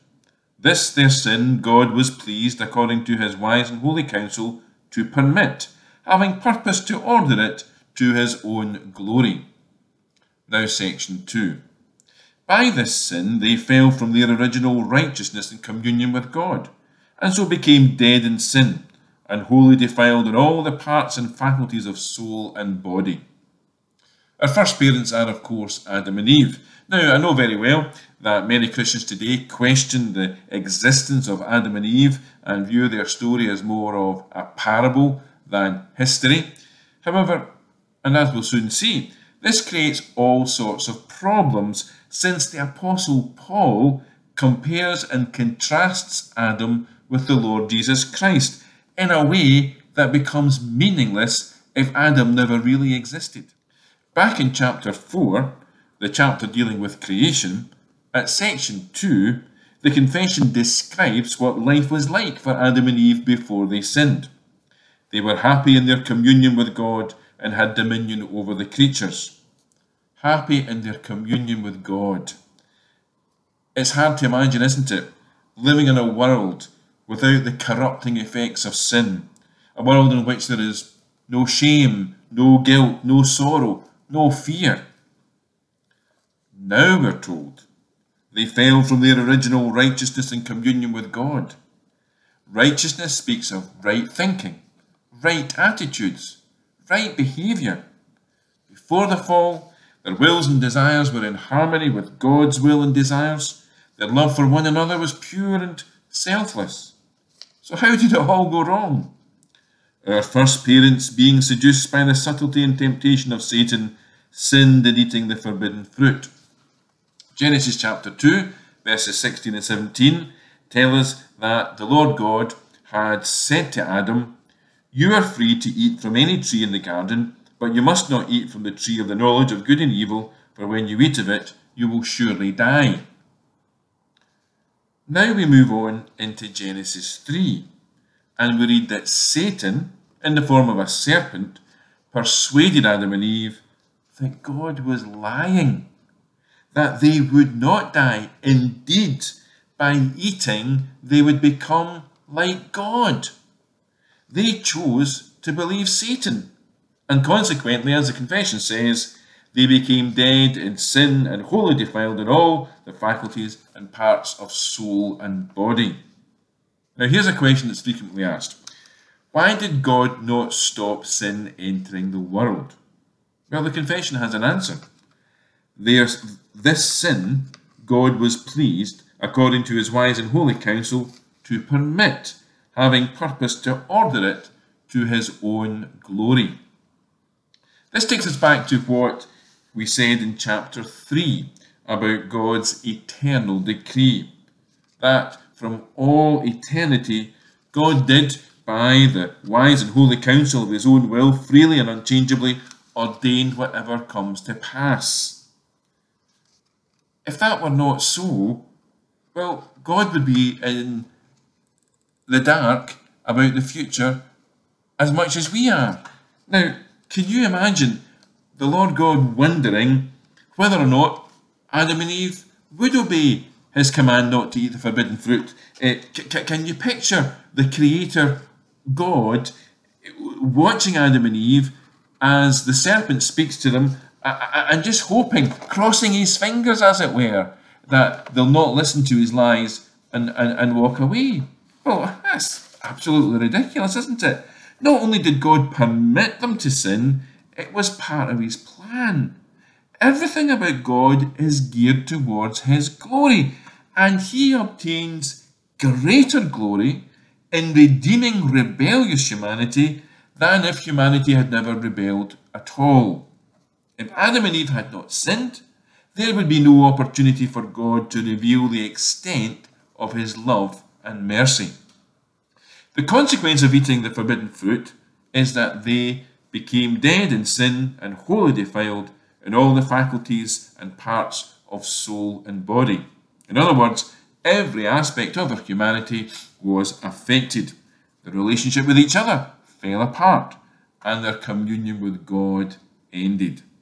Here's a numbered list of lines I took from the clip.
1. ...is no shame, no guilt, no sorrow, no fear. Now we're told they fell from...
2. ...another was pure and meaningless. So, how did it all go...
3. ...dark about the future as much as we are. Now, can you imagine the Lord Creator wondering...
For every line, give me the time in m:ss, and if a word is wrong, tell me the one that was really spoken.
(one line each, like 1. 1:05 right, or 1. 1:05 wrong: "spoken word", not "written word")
1. 1:20 right
2. 1:44 wrong: "selfless", not "meaningless"
3. 3:32 wrong: "God", not "Creator".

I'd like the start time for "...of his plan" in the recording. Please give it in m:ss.
4:08.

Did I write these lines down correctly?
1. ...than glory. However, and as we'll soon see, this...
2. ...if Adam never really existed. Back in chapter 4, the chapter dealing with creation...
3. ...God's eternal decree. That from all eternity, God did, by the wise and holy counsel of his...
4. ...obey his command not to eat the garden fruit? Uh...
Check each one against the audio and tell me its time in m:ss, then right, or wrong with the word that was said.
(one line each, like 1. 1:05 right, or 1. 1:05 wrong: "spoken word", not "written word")
1. 0:35 wrong: "history", not "glory"
2. 0:51 right
3. 3:12 right
4. 3:42 wrong: "forbidden", not "garden".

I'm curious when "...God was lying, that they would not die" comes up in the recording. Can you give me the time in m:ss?
2:24.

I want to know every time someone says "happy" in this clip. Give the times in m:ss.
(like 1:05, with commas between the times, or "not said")
1:05, 1:10.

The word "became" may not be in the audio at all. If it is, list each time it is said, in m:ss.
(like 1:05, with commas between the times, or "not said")
0:17, 2:39, 4:36.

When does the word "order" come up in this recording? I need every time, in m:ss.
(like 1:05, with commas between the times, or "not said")
0:07, 3:03.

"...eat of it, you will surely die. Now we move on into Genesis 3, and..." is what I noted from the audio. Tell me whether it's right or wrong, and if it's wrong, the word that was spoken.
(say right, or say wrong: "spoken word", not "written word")
right.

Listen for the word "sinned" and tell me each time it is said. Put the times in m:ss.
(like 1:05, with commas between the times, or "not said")
1:03, 1:54, 4:25.